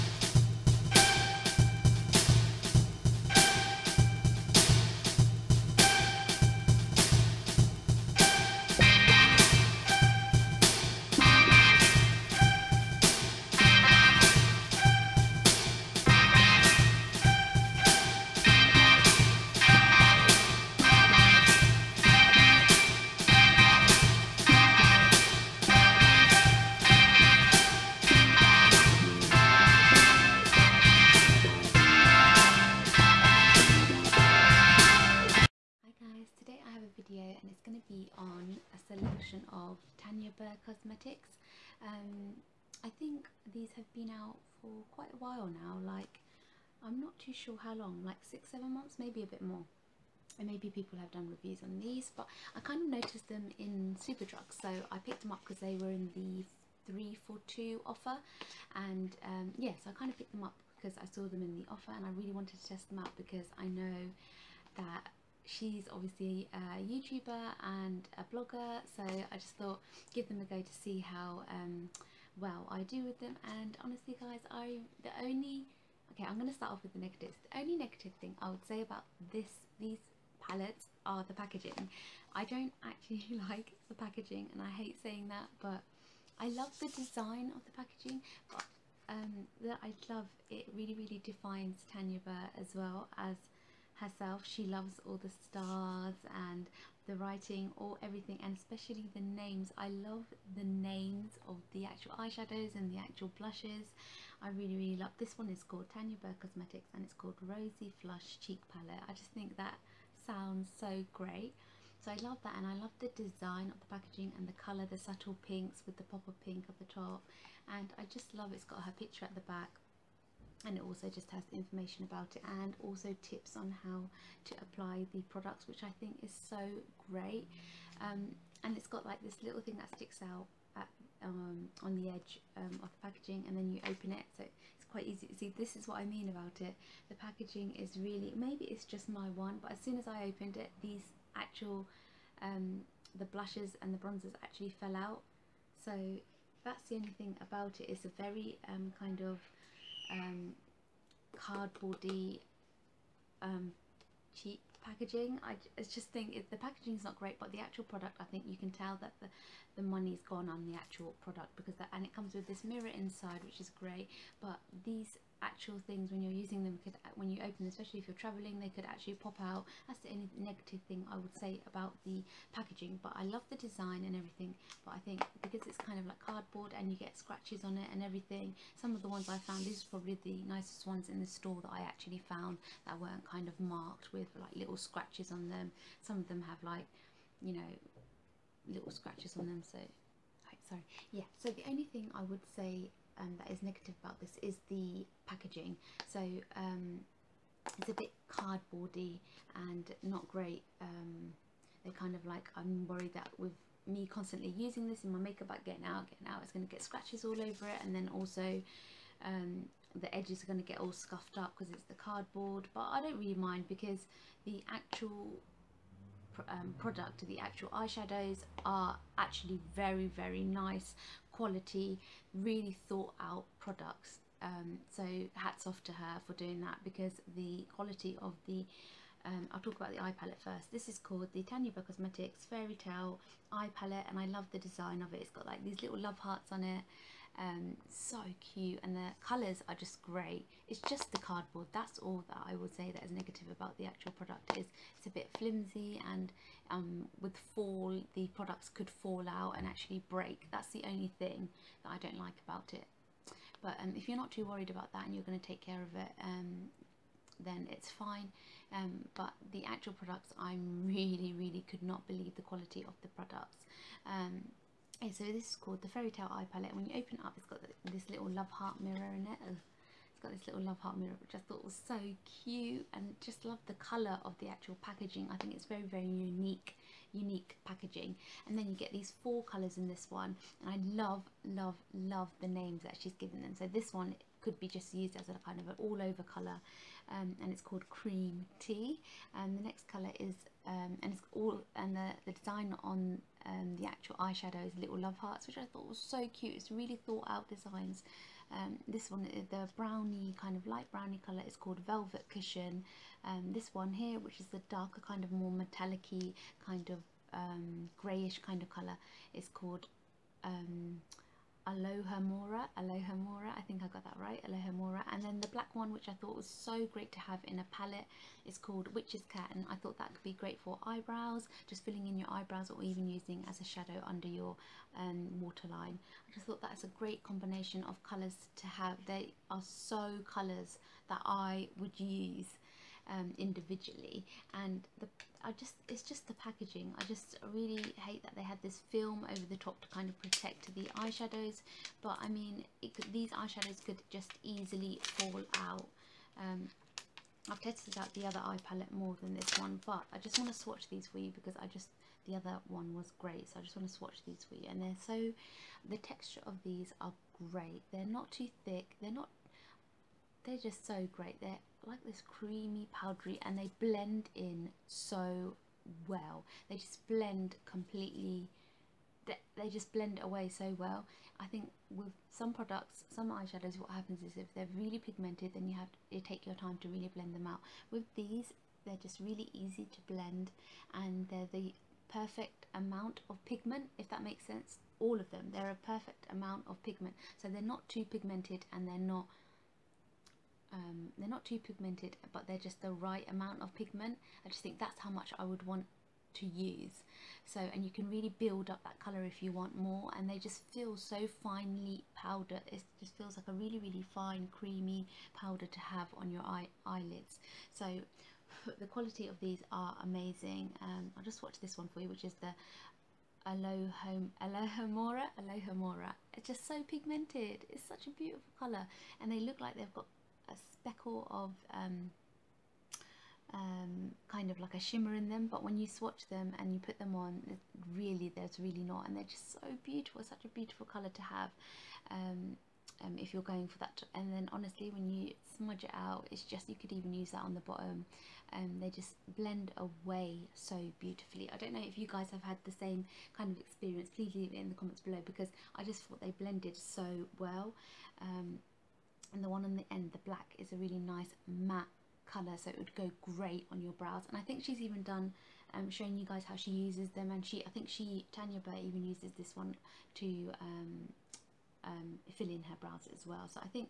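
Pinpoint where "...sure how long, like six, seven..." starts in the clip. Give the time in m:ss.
0:47.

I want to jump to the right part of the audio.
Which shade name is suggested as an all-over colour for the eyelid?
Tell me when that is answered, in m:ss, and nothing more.
4:47.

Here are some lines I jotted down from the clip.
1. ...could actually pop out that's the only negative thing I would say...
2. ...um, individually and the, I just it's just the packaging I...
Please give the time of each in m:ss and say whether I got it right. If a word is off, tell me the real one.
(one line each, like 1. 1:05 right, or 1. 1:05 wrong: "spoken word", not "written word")
1. 2:48 right
2. 5:33 right.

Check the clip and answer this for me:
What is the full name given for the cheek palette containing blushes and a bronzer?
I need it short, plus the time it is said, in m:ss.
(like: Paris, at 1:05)
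Rosy Flush Cheek Palette, at 1:47.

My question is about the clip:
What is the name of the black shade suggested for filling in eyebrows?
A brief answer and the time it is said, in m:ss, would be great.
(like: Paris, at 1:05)
Witch's Cat, at 5:18.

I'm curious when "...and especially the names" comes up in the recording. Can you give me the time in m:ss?
1:38.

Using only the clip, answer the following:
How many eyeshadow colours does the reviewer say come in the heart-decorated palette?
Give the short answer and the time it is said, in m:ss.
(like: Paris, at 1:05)
4, at 4:39.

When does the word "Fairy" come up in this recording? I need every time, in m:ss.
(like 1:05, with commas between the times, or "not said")
3:52, 4:25.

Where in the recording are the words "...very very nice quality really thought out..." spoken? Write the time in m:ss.
3:39.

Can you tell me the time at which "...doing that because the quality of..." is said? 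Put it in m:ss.
3:46.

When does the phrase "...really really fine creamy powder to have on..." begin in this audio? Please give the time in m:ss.
6:43.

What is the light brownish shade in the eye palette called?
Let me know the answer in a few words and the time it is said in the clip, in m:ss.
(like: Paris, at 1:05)
Velvet Cushion, at 5:01.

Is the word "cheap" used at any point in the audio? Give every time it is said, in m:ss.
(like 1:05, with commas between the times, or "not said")
2:34.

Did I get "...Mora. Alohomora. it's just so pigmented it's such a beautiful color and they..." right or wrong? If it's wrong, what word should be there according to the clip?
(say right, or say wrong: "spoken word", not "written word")
right.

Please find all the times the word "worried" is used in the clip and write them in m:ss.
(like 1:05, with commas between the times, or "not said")
3:22, 4:14.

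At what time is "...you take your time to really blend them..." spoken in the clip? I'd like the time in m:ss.
6:16.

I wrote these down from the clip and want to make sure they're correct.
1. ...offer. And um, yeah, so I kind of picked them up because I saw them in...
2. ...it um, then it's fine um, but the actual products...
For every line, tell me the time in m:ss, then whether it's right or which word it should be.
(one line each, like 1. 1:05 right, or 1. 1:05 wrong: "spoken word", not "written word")
1. 0:57 right
2. 4:15 right.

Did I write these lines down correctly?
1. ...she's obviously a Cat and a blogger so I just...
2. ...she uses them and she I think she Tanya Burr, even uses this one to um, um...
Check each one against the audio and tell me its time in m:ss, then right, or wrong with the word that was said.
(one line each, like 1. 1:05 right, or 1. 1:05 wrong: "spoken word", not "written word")
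1. 1:05 wrong: "YouTuber", not "Cat"
2. 7:36 right.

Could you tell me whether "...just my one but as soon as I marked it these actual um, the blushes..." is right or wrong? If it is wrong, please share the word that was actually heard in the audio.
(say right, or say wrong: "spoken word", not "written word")
wrong: "opened", not "marked".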